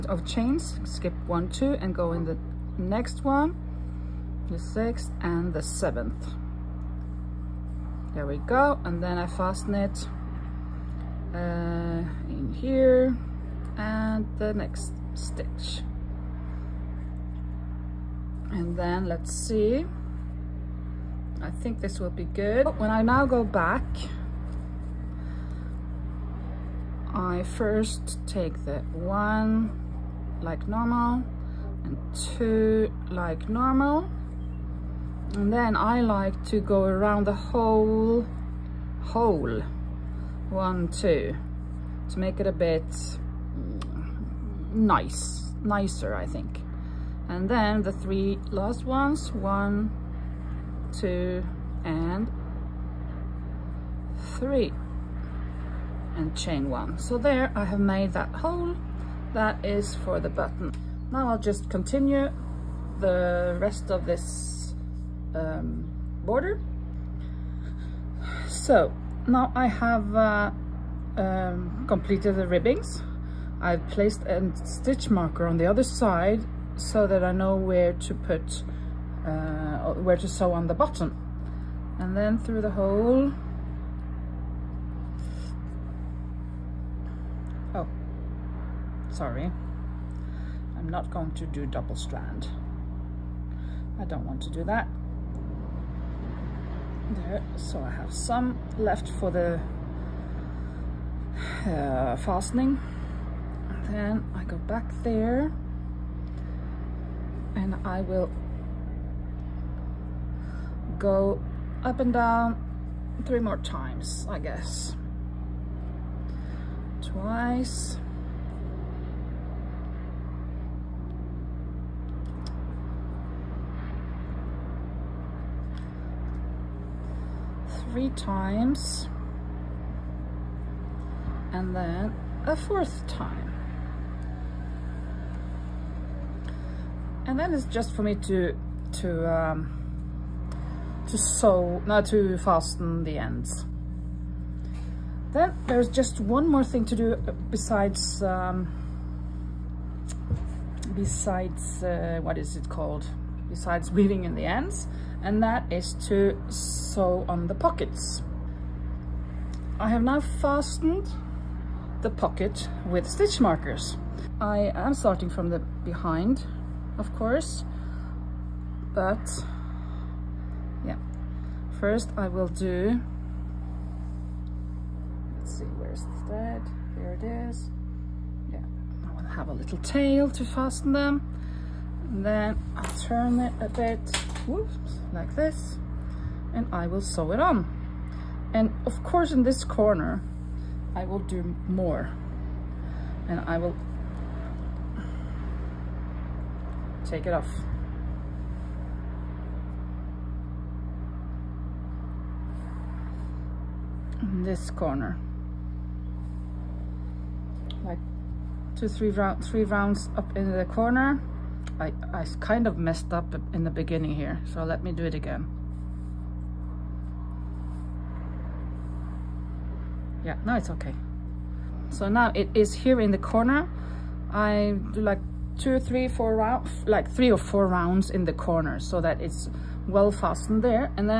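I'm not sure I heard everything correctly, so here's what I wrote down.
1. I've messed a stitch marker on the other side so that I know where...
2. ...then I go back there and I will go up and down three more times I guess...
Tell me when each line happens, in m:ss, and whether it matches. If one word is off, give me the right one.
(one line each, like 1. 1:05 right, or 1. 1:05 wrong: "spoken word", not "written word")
1. 1:13 wrong: "placed", not "messed"
2. 1:43 right.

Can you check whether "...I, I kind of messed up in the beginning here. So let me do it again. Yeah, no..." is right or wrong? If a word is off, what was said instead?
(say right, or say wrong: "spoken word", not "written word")
right.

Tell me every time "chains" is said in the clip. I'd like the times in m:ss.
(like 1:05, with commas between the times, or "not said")
0:00, 0:56.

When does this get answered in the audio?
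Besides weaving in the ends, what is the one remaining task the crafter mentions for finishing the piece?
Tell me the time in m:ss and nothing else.
2:36.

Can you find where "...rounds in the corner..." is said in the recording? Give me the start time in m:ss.
3:47.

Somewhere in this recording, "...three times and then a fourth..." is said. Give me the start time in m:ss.
2:07.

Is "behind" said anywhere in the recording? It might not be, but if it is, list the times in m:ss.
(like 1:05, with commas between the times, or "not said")
2:45.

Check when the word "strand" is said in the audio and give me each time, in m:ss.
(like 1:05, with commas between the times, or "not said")
1:31.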